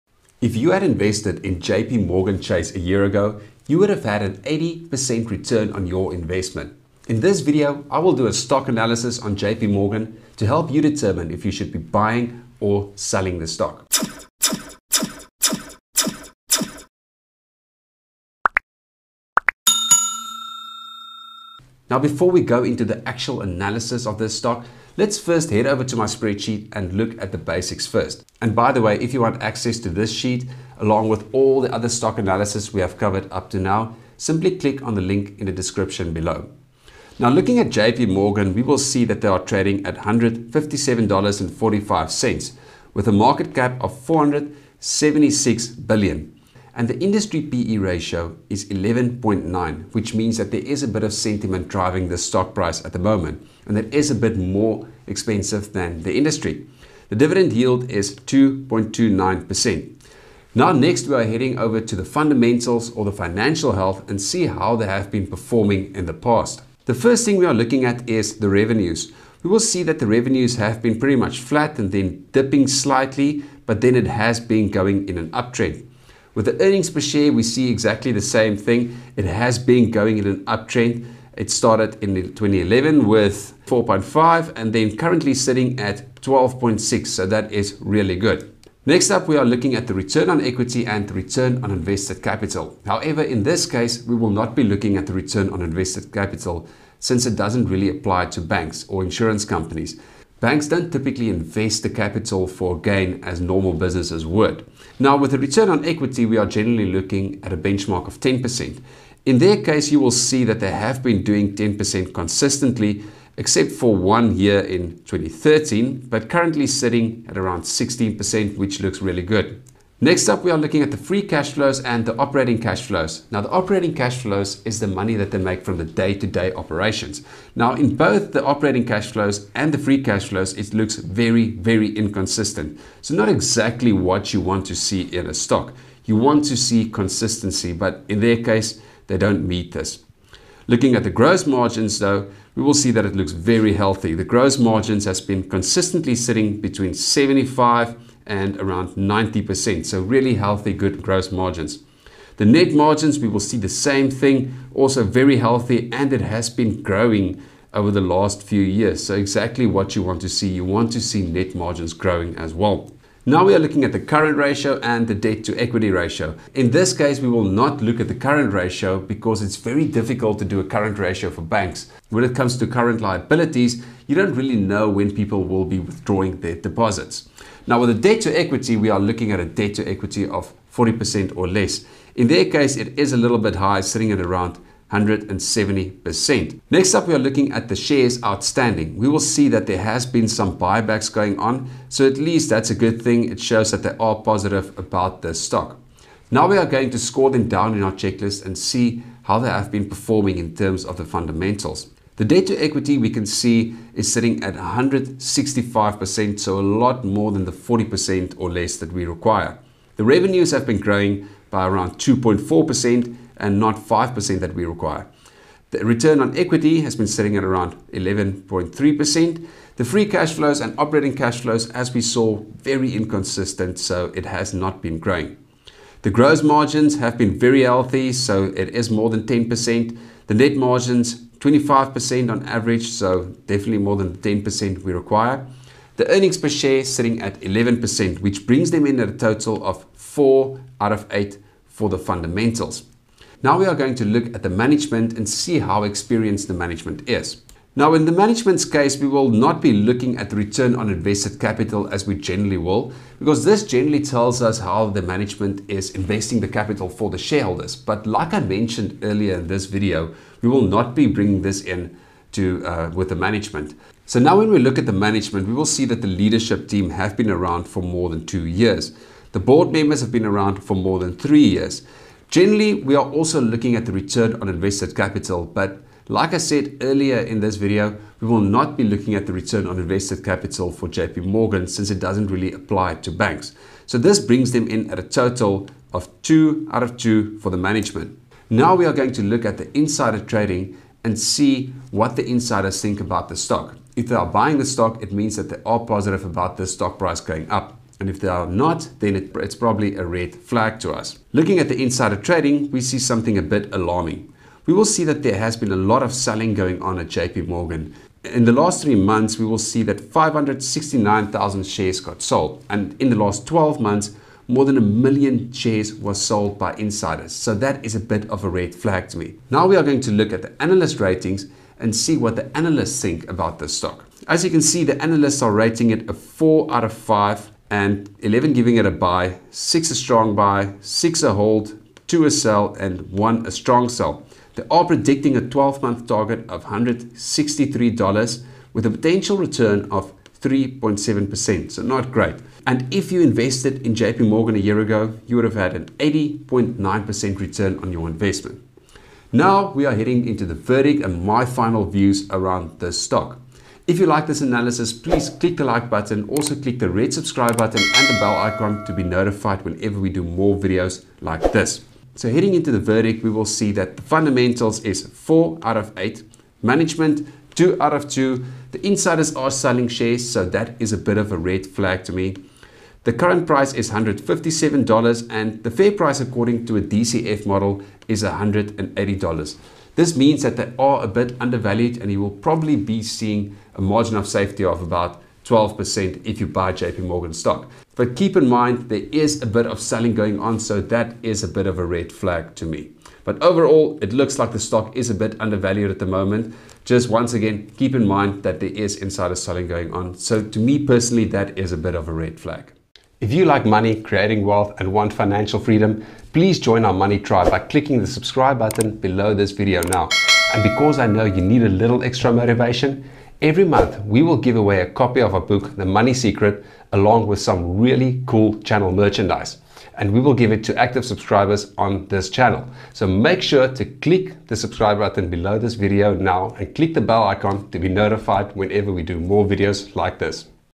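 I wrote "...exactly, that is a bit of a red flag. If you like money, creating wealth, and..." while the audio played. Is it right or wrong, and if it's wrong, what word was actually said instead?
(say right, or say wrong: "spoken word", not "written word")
wrong: "personally", not "exactly".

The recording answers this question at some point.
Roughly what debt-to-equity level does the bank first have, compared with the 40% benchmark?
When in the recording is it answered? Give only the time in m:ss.
3:04.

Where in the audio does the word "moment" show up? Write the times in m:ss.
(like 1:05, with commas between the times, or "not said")
0:52, 6:36.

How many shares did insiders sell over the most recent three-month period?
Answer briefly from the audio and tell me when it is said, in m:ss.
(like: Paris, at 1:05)
569,000, at 5:10.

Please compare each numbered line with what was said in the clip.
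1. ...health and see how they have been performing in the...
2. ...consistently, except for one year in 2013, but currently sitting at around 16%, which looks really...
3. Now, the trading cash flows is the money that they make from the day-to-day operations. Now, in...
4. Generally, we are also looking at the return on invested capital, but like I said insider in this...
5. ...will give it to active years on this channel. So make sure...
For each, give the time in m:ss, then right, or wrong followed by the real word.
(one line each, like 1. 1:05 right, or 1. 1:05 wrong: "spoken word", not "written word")
1. 1:03 right
2. 1:52 right
3. 2:03 wrong: "operating", not "trading"
4. 4:32 wrong: "earlier", not "insider"
5. 7:00 wrong: "subscribers", not "years".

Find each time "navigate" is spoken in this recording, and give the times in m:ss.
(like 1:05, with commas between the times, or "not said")
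not said.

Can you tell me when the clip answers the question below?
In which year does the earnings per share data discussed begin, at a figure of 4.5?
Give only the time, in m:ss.
1:22.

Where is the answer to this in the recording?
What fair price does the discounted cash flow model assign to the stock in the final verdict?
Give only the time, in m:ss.
6:18.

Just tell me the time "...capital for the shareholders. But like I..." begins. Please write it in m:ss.
4:16.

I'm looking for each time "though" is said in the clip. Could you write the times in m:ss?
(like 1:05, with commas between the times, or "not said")
2:21.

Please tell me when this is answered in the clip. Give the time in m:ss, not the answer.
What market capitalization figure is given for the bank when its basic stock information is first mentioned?
0:44.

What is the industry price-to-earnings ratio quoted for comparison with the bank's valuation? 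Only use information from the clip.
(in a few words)
11.9.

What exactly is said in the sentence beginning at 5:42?
And if you invested in JP Morgan a year ago, you would have had an 80.9% return on your investment.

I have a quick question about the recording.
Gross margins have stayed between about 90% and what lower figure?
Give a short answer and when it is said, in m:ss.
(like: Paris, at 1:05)
75%, at 2:26.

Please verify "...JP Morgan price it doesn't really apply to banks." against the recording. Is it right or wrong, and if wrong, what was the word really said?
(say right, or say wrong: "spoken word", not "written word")
wrong: "since", not "price".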